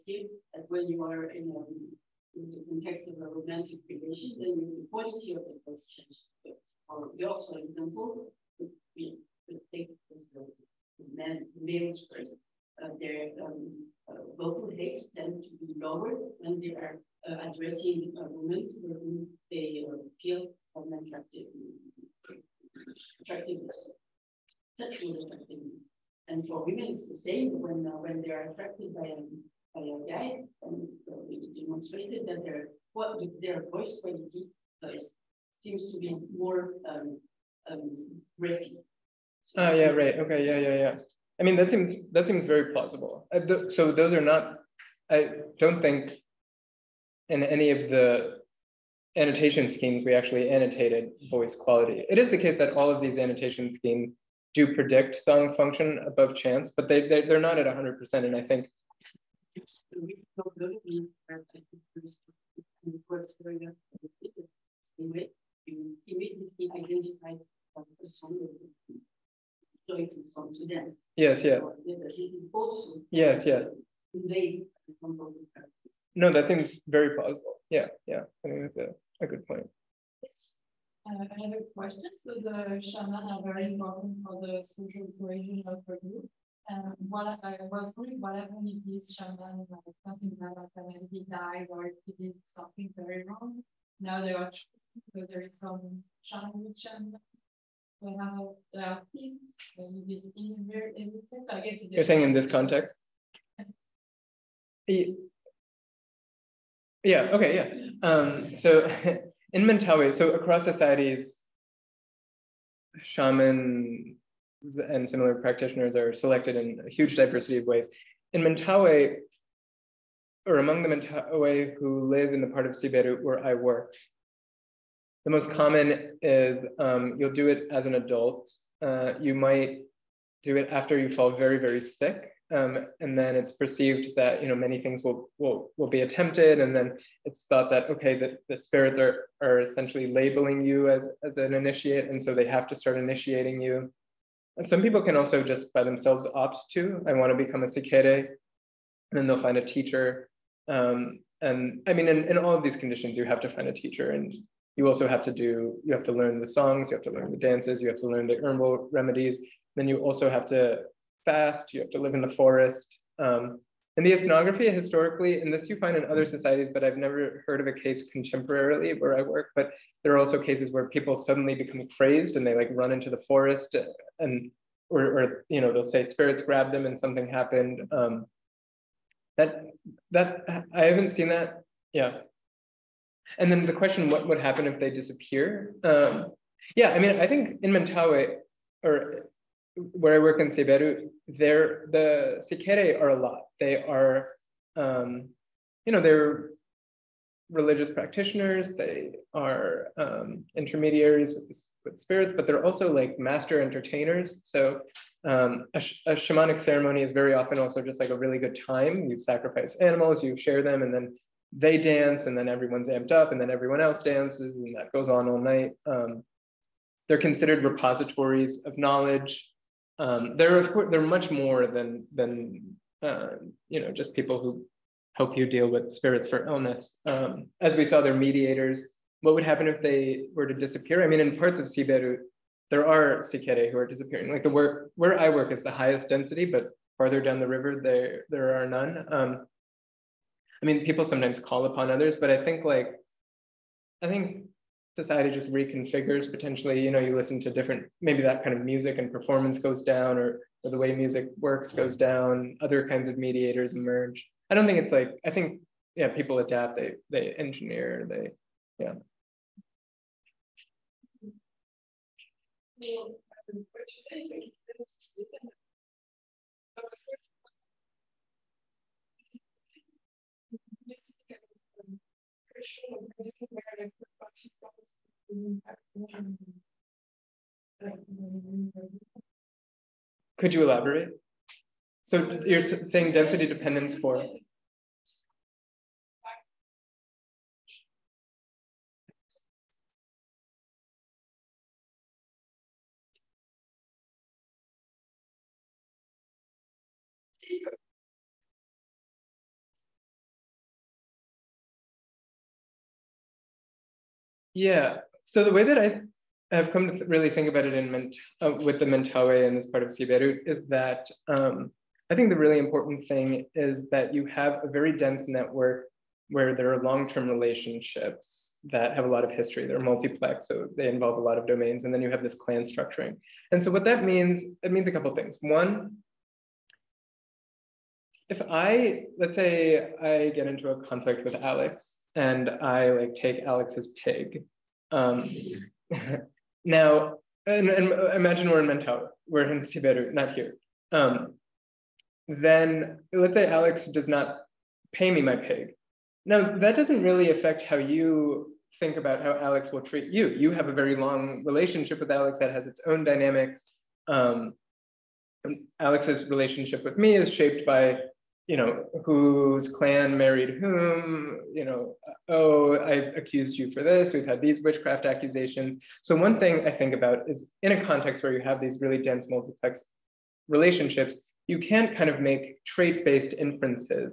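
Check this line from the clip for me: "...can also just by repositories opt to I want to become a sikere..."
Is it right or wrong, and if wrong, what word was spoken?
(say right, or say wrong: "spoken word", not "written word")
wrong: "themselves", not "repositories".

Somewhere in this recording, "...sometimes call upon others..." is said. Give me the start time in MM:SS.
04:01.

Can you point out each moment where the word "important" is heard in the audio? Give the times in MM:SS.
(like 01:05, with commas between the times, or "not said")
01:23, 05:12.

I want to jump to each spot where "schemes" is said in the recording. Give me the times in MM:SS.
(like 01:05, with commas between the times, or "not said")
00:49, 00:53.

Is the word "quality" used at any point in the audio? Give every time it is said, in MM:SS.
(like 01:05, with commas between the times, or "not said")
00:04, 00:34, 00:51.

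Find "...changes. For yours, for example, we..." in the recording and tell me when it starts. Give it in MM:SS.
00:05.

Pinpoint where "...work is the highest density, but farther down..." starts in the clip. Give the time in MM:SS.
03:55.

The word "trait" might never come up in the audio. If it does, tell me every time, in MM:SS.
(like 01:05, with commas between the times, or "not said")
06:12.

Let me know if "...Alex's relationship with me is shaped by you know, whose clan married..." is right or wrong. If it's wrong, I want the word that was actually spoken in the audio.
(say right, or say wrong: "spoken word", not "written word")
right.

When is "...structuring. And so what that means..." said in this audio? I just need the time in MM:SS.
05:22.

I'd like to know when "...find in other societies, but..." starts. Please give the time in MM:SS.
02:45.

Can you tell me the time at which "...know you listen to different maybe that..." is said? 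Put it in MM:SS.
04:06.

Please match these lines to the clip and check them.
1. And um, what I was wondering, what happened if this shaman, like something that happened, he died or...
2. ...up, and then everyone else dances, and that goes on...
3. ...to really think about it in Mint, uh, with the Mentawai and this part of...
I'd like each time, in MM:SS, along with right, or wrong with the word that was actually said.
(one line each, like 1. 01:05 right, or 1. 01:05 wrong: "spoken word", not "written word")
1. 01:26 right
2. 03:33 right
3. 05:06 right.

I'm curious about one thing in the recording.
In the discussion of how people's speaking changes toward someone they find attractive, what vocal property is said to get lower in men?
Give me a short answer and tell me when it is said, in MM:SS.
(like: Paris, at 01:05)
vocal rates, at 00:14.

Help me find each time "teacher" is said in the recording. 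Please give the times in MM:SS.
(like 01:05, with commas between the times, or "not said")
02:29, 02:33.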